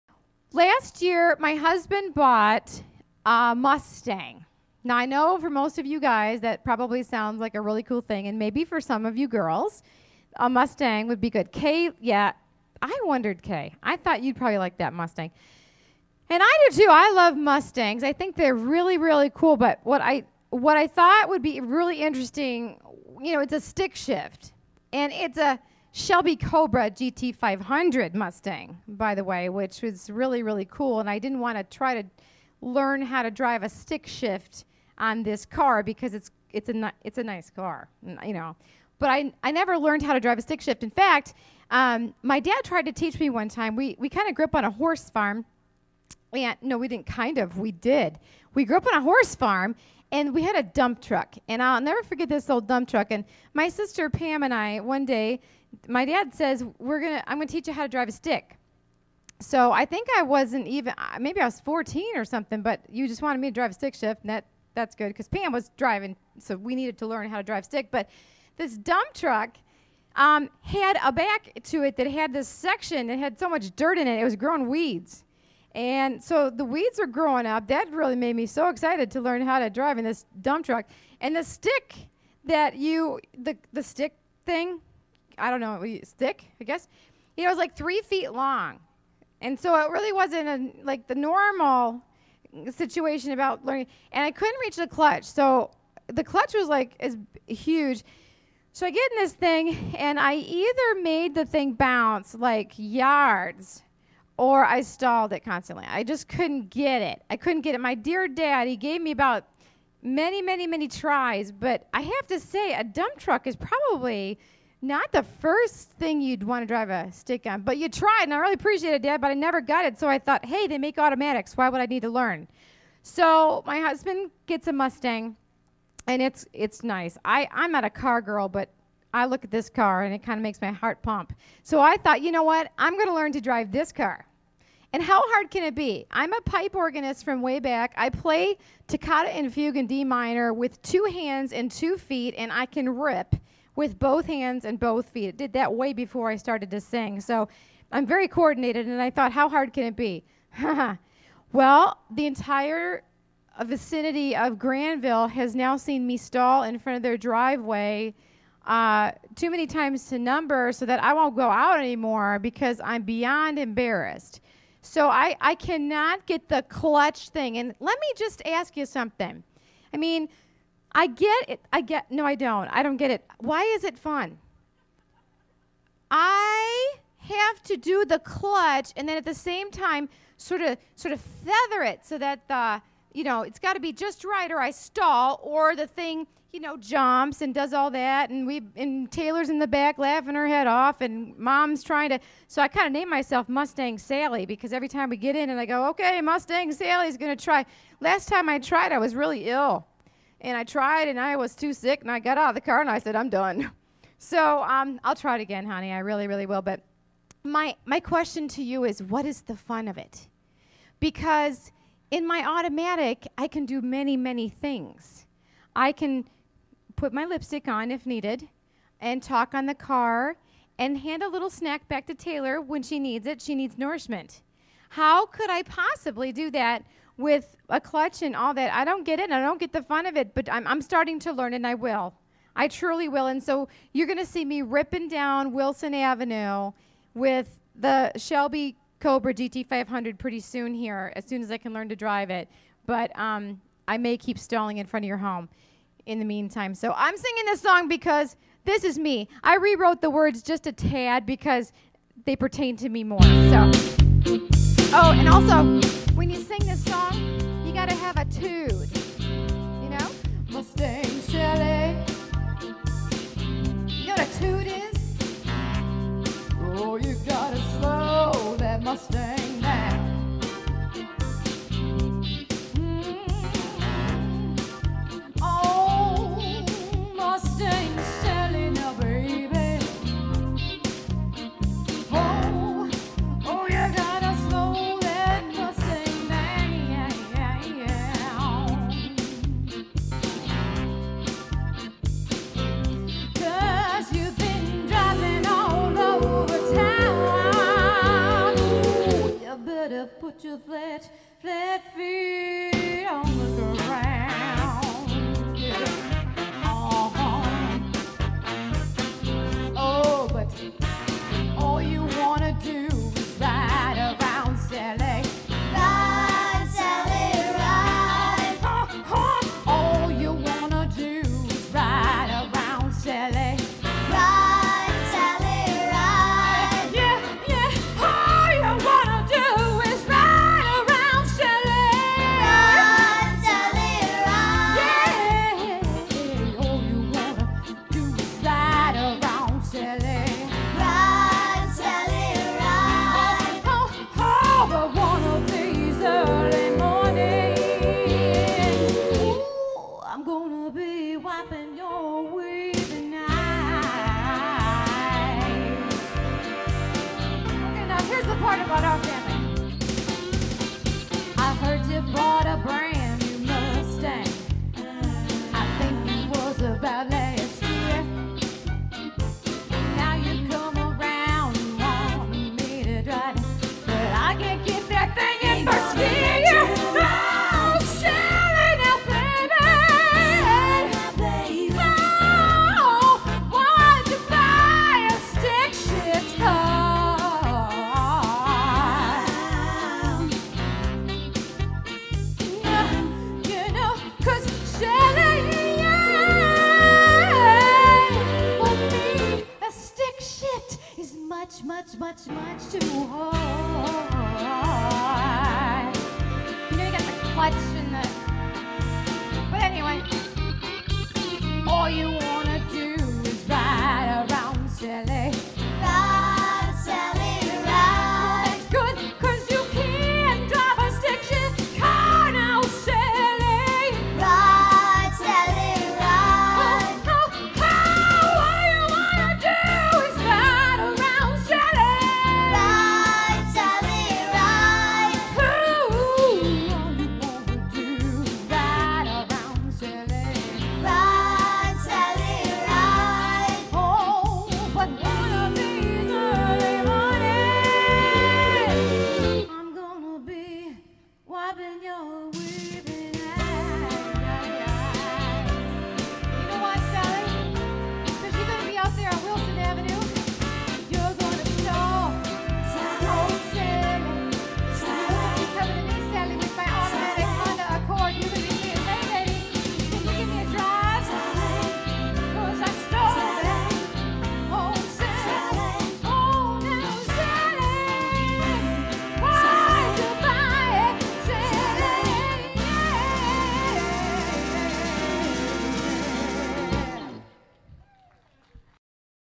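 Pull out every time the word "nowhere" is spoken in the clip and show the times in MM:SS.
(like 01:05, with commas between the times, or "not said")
not said.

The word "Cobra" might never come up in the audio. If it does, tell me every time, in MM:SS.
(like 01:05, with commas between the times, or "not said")
00:26, 03:59.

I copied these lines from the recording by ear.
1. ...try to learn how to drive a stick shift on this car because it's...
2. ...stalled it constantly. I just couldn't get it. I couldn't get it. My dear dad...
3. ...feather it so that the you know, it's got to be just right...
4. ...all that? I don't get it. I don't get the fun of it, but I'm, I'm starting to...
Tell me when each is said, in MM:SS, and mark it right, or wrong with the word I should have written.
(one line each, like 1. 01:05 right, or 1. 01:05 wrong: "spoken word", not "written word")
1. 00:31 right
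2. 01:44 right
3. 03:01 right
4. 03:48 right.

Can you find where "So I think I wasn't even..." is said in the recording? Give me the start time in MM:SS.
00:59.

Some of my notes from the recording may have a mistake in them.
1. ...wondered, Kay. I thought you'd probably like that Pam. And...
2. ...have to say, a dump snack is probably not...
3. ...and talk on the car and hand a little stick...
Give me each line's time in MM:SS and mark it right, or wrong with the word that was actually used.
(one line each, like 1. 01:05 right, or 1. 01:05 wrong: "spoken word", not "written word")
1. 00:13 wrong: "Mustang", not "Pam"
2. 01:52 wrong: "truck", not "snack"
3. 03:38 wrong: "snack", not "stick".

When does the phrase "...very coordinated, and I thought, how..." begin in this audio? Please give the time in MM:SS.
02:28.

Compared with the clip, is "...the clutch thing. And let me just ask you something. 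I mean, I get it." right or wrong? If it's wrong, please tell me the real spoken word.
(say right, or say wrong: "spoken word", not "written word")
right.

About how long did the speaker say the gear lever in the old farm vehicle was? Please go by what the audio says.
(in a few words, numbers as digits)
3 feet.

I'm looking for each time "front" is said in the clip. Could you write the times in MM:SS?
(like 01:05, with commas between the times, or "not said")
02:36, 04:04.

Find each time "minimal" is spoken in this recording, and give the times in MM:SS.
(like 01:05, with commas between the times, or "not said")
not said.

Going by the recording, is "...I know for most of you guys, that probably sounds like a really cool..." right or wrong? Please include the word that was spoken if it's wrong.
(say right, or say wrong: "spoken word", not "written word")
right.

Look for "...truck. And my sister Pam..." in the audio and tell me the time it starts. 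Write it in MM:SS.
00:52.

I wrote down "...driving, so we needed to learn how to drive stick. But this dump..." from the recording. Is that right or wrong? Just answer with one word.
right.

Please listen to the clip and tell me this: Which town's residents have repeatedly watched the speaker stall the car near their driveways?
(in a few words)
Granville.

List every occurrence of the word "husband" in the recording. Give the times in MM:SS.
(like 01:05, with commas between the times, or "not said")
00:01, 02:03.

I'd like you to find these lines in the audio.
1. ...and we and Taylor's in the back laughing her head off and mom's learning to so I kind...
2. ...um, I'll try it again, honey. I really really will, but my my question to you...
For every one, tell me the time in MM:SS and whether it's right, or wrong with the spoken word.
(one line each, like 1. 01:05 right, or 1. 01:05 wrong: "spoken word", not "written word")
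1. 03:08 wrong: "trying", not "learning"
2. 03:24 right.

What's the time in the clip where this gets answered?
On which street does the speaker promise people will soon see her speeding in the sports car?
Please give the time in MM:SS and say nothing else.
03:55.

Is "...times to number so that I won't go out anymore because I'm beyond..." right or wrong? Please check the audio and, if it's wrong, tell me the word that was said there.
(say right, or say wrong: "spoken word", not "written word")
right.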